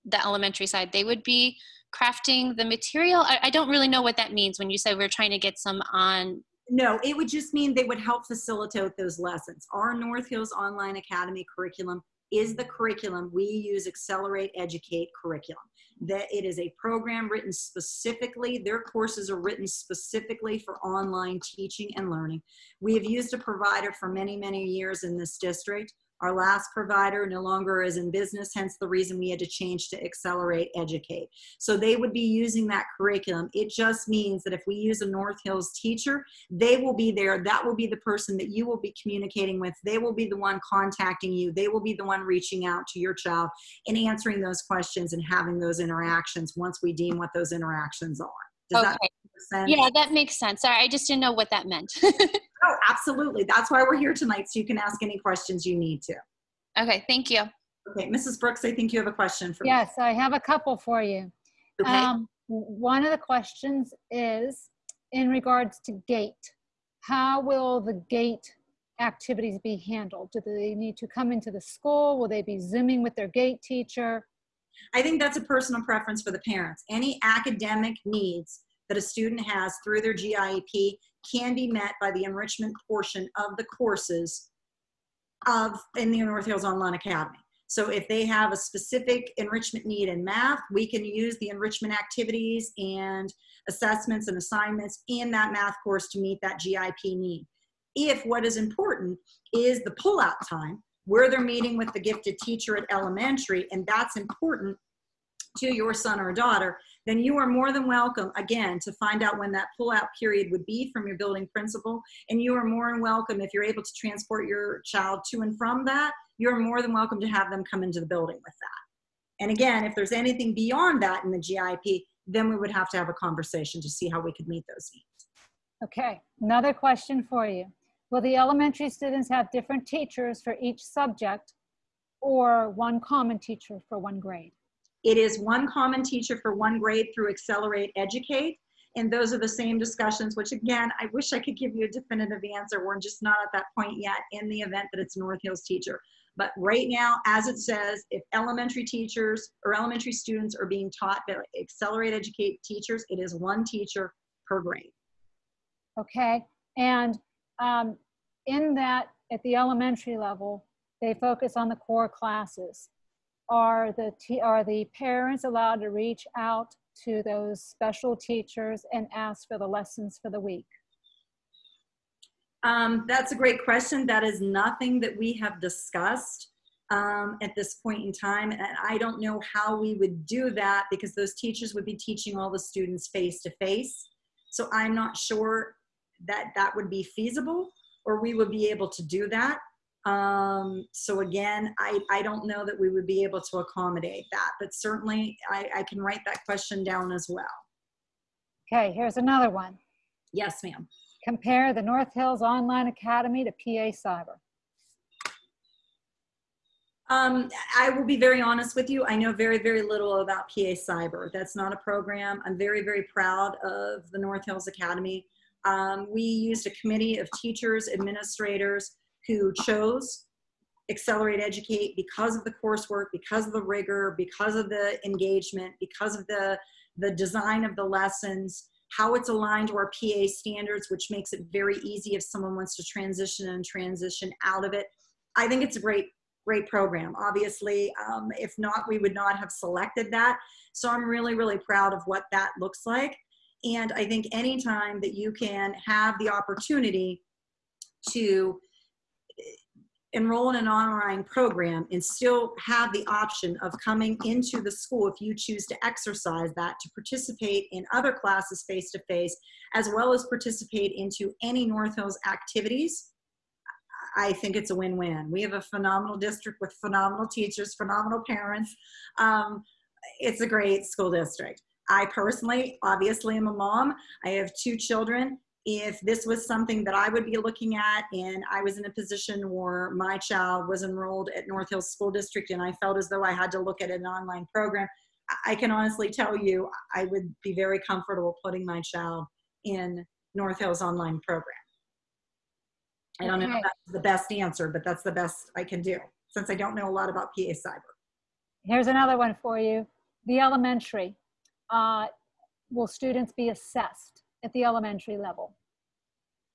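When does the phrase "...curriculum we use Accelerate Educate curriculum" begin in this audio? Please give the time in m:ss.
0:12.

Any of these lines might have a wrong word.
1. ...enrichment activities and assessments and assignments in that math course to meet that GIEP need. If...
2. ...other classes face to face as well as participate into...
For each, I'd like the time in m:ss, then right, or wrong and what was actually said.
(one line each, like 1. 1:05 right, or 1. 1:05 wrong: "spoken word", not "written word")
1. 1:31 right
2. 4:17 right.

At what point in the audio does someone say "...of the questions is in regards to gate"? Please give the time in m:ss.
1:03.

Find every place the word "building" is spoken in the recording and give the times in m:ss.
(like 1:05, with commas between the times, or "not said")
1:51, 1:58.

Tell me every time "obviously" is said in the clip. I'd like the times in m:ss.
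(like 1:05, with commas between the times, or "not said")
3:57, 4:32.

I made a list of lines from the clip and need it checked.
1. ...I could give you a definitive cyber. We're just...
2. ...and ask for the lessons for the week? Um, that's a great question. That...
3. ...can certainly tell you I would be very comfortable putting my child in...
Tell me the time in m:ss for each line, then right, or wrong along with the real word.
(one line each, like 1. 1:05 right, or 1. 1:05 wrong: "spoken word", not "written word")
1. 2:21 wrong: "answer", not "cyber"
2. 2:48 right
3. 4:45 wrong: "honestly", not "certainly".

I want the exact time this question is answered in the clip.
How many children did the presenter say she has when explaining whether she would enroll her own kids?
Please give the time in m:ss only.
4:34.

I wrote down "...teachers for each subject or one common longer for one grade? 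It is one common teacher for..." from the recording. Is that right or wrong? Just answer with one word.
wrong.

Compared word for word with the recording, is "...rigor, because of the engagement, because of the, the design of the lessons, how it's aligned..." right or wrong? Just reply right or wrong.
right.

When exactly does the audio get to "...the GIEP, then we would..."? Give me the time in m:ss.
2:01.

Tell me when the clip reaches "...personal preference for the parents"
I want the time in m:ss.
1:15.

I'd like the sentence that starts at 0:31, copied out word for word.
So they would be using that curriculum.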